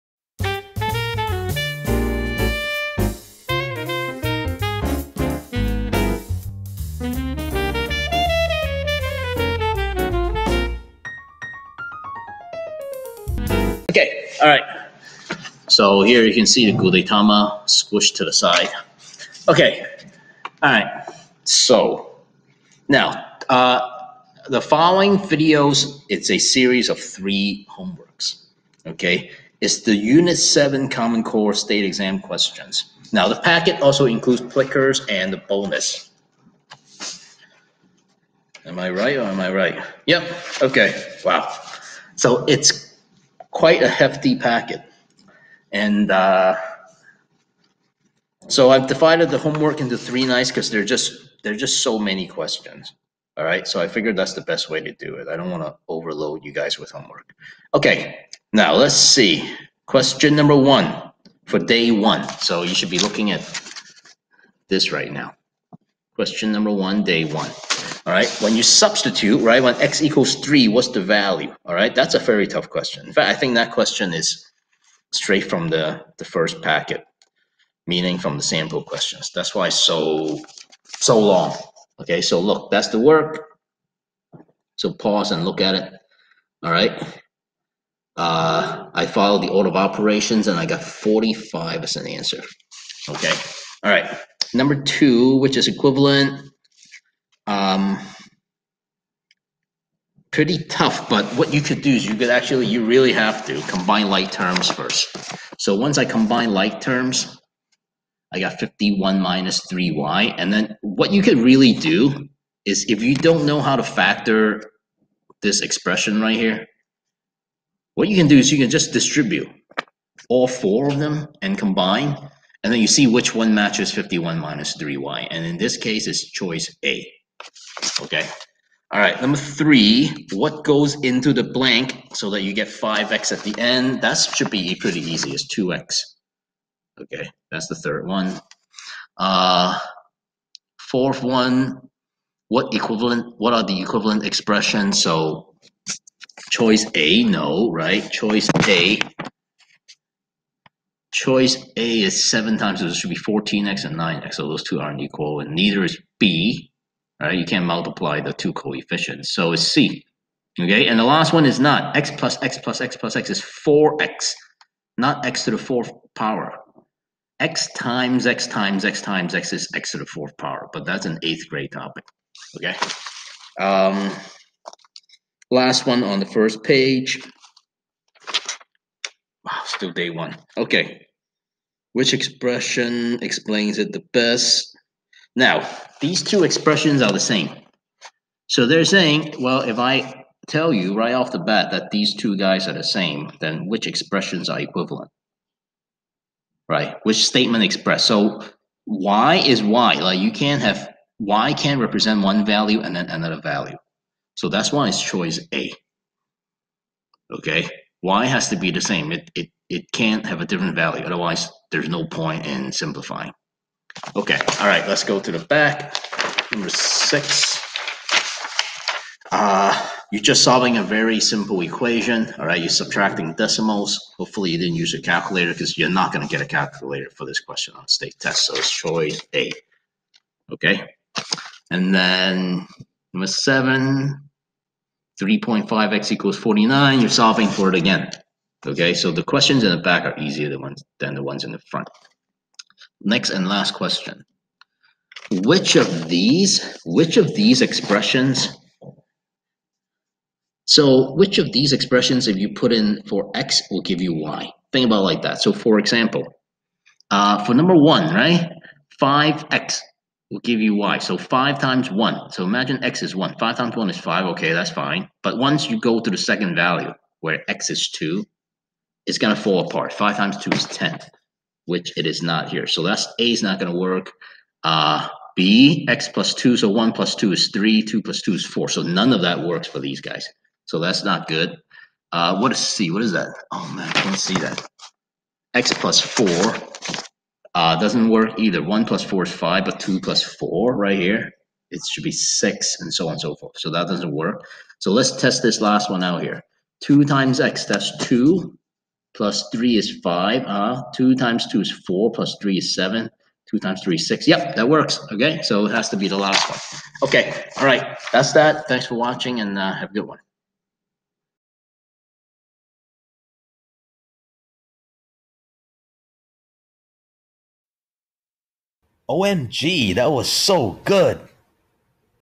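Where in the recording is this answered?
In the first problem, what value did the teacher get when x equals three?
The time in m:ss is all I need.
1:30.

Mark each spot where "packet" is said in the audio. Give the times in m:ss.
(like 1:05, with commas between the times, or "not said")
0:33, 0:44, 1:16.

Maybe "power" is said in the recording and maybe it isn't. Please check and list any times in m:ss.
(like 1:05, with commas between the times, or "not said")
2:46, 2:50.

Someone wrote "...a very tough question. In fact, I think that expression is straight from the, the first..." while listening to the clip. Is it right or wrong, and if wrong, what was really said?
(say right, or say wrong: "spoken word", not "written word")
wrong: "question", not "expression".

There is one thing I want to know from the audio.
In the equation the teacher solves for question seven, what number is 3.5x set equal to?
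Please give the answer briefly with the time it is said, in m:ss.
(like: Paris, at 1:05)
49, at 3:56.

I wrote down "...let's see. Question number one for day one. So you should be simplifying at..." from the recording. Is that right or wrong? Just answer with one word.
wrong.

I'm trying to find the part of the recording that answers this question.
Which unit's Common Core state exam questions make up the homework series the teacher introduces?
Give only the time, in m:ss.
0:29.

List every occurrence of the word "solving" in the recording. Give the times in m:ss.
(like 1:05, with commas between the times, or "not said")
3:40, 3:57.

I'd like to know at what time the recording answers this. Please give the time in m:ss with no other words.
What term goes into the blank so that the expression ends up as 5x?
2:15.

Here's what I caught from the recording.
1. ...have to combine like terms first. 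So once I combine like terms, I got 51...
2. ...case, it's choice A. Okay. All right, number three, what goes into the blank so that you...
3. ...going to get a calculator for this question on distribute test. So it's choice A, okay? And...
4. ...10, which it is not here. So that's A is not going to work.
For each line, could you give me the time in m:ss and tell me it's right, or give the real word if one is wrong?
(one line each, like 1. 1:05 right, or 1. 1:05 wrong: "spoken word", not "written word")
1. 1:43 right
2. 2:05 right
3. 3:46 wrong: "state", not "distribute"
4. 4:30 right.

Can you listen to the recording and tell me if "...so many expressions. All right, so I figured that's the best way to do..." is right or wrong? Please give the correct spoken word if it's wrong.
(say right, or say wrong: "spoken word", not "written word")
wrong: "questions", not "expressions".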